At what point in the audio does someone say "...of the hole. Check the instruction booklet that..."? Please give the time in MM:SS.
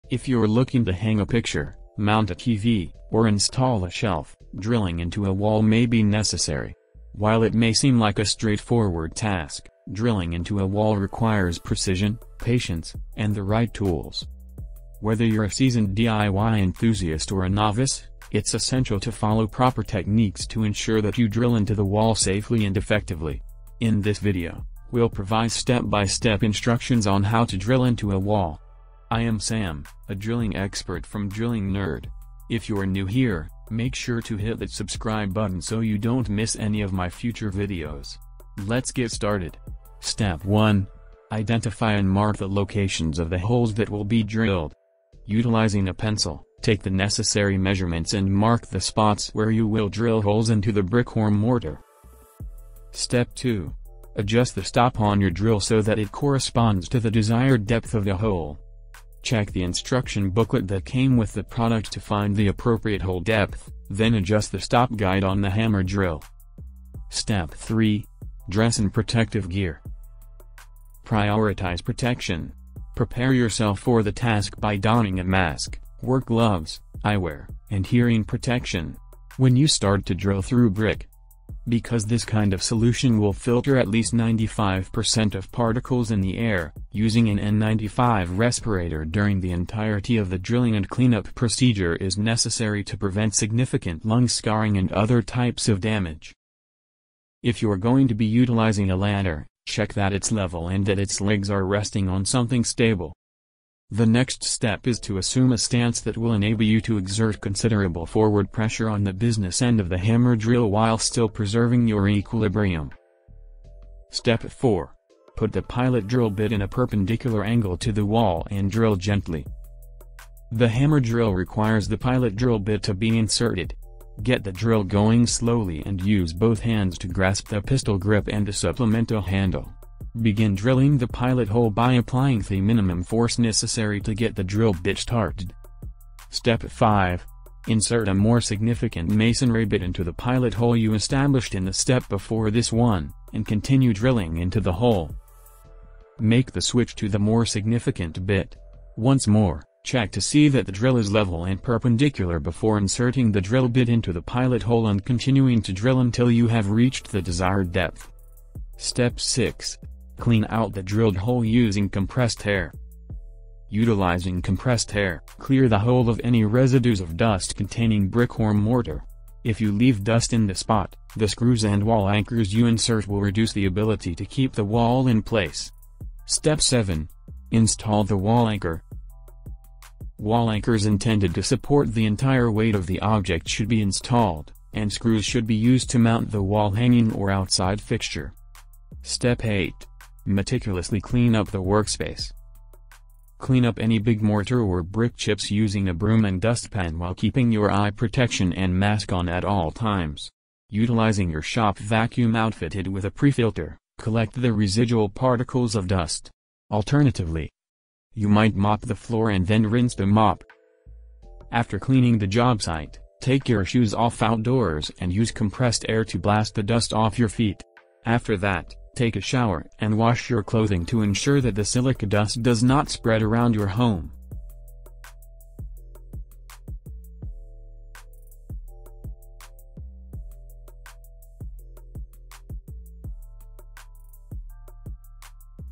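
00:57.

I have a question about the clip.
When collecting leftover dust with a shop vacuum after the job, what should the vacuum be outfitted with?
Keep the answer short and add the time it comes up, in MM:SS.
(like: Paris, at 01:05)
a pre-filter, at 03:23.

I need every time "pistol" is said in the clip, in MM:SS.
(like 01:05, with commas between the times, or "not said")
02:07.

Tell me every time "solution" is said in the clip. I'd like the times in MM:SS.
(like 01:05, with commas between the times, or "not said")
01:22.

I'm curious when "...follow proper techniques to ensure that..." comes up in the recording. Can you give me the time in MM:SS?
00:19.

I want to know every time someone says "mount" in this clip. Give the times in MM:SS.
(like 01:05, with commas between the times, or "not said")
00:01, 03:05.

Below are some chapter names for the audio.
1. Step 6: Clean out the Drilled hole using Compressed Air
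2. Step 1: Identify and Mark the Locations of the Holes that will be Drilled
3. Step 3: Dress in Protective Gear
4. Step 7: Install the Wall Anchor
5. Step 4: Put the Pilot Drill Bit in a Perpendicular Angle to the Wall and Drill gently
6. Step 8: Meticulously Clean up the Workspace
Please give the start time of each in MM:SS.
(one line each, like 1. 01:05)
1. 02:40
2. 00:40
3. 01:08
4. 02:57
5. 01:55
6. 03:09.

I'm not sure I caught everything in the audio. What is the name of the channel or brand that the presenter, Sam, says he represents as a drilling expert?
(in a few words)
Drilling Nerd.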